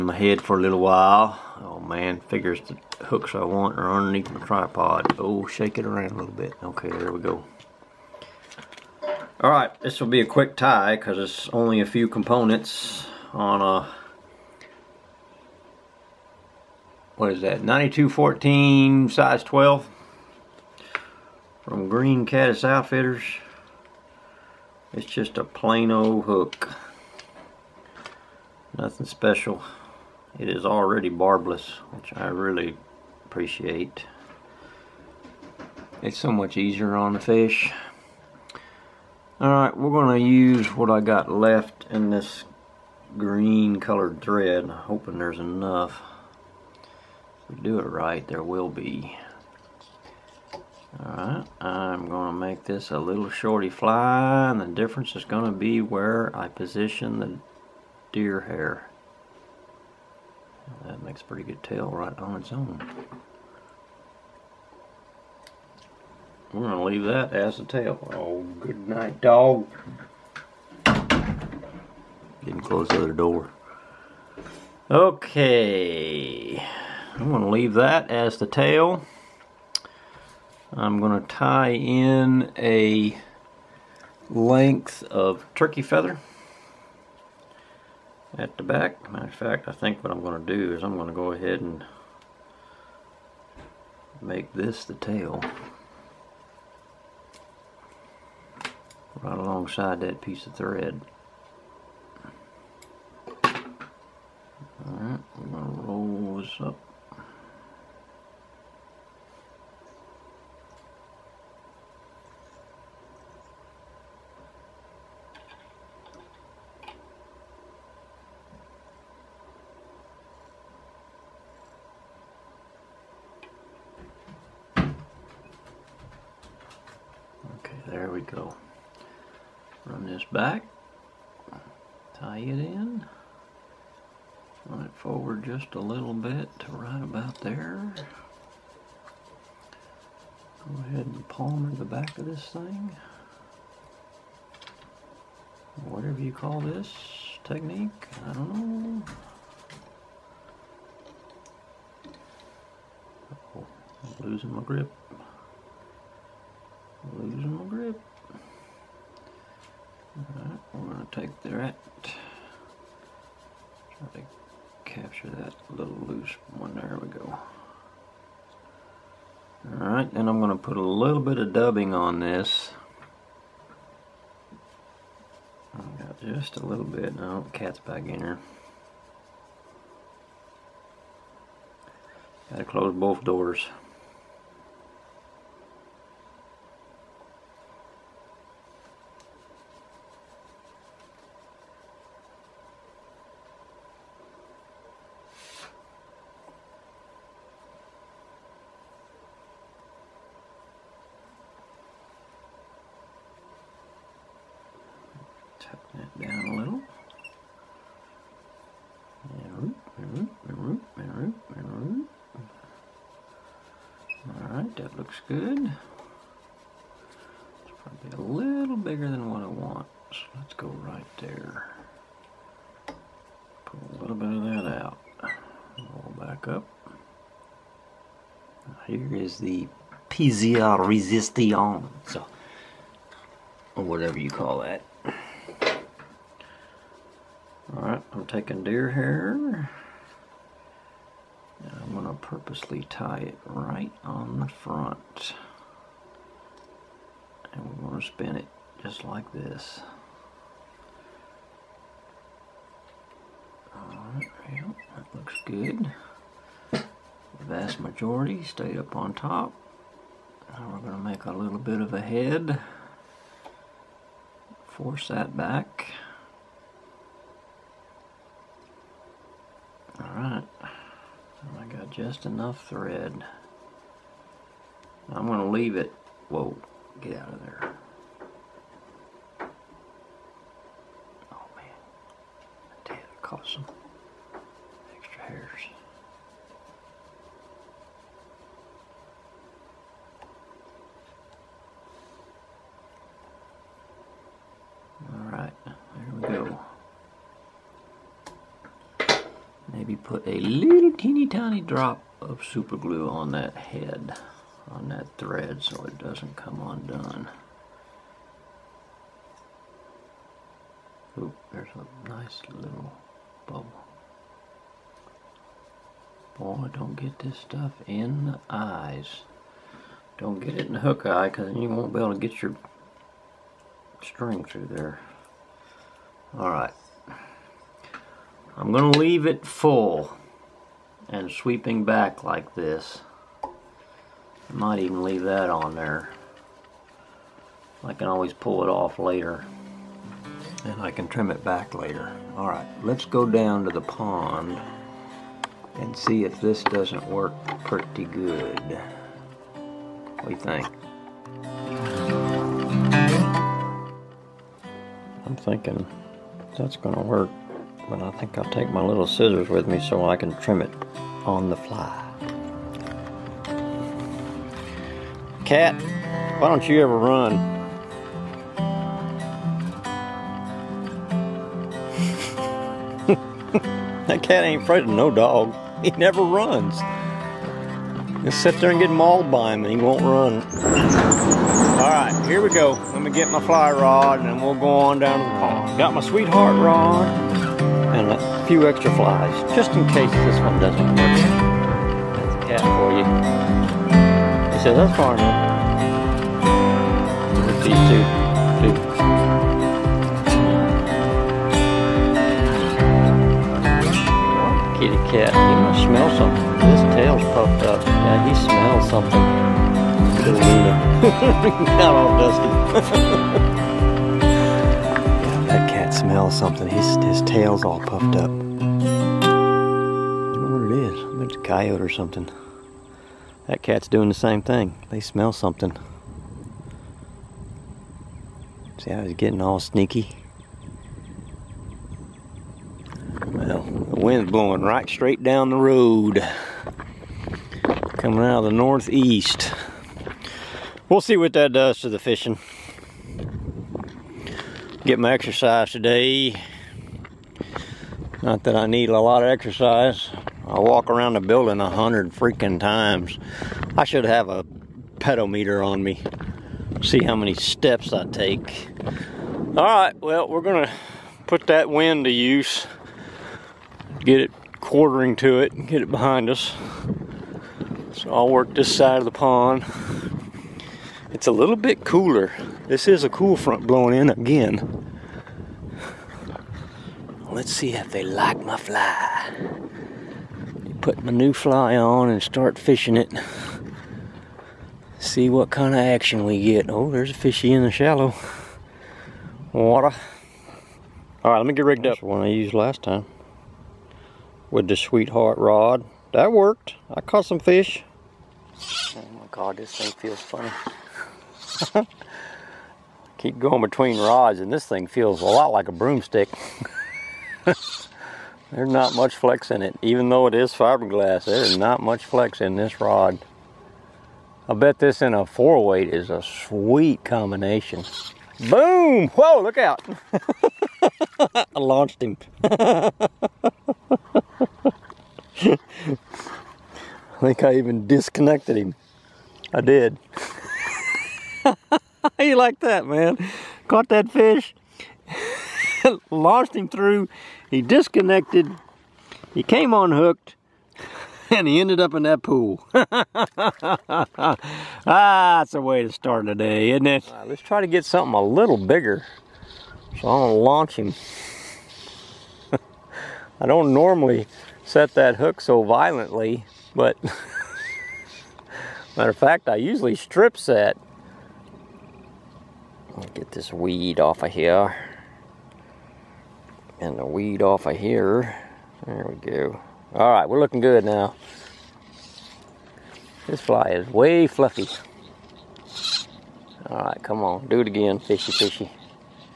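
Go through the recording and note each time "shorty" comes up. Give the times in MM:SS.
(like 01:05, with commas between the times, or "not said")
00:53.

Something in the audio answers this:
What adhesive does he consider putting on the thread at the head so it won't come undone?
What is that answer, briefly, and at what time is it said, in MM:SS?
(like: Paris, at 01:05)
Super glue, at 05:02.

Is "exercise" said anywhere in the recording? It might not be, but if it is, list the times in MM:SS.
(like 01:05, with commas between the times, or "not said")
07:25, 07:29.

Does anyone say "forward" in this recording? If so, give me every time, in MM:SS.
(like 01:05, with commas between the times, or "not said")
02:14.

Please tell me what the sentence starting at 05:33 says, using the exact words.
I might even leave that on there.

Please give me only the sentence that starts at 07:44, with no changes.
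Get it quartering to it and get it behind us.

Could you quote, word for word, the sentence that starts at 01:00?
That makes a pretty good tail right on its own.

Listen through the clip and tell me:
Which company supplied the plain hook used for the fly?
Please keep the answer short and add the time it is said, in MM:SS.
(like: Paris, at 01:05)
Green Caddis Outfitters, at 00:21.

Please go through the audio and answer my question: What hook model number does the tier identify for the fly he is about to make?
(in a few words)
9214.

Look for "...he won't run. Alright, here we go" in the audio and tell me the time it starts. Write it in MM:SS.
06:19.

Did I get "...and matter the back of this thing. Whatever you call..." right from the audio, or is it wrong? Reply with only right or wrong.
wrong.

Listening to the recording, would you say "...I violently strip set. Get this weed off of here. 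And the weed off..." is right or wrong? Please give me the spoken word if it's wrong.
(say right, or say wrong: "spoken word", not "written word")
wrong: "usually", not "violently".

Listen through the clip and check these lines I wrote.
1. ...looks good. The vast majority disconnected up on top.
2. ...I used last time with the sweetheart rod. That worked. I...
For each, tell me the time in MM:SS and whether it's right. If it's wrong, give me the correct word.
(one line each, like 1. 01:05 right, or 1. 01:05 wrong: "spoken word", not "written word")
1. 04:15 wrong: "stayed", not "disconnected"
2. 08:12 right.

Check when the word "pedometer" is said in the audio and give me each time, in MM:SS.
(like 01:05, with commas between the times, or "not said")
07:34.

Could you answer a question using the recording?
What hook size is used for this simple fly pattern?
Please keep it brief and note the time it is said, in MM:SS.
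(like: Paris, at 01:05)
12, at 00:19.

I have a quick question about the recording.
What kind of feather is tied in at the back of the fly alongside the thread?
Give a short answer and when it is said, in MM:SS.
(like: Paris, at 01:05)
Turkey feather, at 01:25.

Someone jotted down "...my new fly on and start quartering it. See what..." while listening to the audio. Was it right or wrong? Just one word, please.
wrong.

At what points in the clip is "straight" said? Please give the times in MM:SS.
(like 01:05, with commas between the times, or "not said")
07:14.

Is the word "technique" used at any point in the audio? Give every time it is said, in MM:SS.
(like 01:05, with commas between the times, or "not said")
02:27.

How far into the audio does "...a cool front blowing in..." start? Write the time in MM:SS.
07:53.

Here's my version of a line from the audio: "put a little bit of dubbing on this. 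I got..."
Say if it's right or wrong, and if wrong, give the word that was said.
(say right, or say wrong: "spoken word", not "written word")
right.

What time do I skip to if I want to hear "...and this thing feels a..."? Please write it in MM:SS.
08:24.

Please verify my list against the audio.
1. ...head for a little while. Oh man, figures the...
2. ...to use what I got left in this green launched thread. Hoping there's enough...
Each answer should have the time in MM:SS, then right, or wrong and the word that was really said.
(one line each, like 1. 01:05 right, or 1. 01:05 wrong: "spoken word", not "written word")
1. 00:00 right
2. 00:40 wrong: "colored", not "launched".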